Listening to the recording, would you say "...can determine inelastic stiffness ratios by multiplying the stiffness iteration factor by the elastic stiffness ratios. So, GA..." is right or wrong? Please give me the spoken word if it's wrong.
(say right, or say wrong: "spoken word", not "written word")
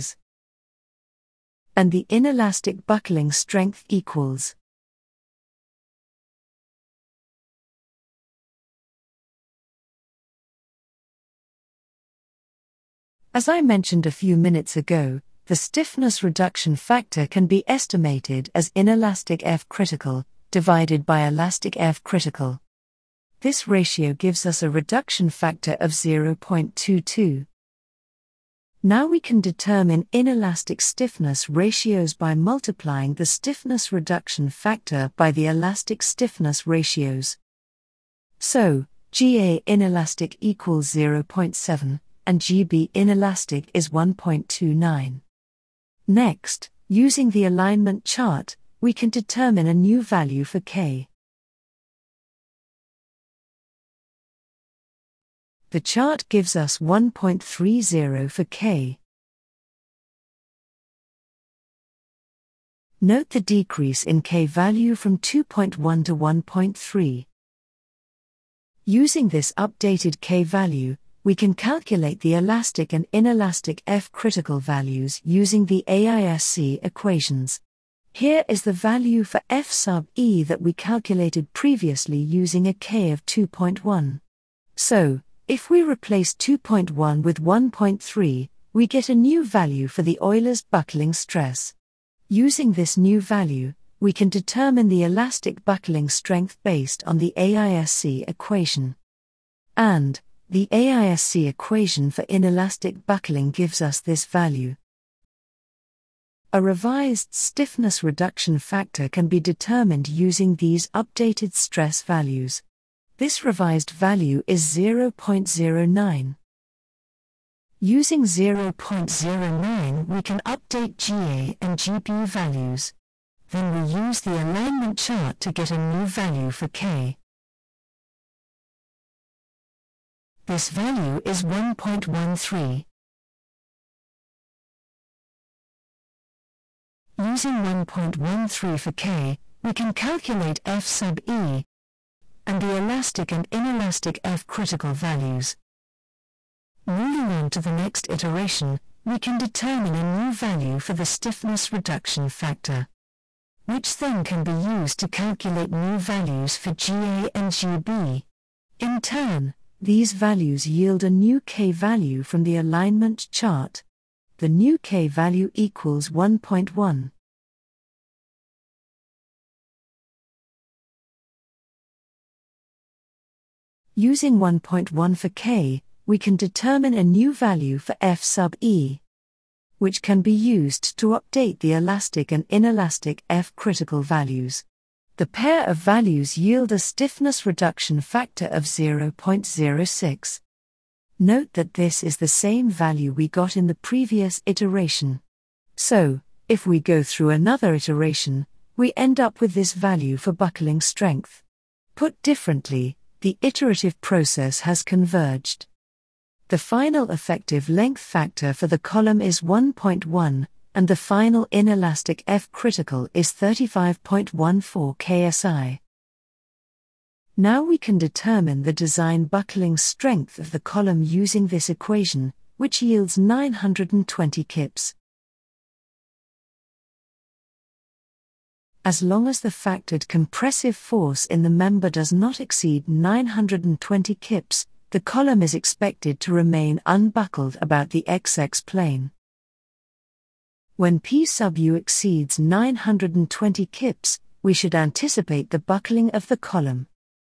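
wrong: "reduction", not "iteration".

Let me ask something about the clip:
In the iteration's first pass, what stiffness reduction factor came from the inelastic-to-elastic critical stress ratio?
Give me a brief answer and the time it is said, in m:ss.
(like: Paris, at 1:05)
0.22, at 0:25.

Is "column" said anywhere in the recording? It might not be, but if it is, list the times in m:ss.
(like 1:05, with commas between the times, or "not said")
3:28, 3:40, 3:55, 4:06.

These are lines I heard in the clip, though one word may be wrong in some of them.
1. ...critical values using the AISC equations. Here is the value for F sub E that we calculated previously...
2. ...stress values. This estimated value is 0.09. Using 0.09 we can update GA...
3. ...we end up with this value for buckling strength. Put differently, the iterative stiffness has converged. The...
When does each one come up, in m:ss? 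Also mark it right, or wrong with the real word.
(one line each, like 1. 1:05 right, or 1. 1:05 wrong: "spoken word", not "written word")
1. 1:14 right
2. 1:51 wrong: "revised", not "estimated"
3. 3:18 wrong: "process", not "stiffness".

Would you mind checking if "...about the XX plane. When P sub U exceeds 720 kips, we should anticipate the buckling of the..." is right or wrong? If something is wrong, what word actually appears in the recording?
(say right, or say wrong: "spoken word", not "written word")
wrong: "920", not "720".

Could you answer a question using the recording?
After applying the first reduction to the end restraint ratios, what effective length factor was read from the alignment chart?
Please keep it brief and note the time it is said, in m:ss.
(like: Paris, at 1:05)
1.30, at 0:56.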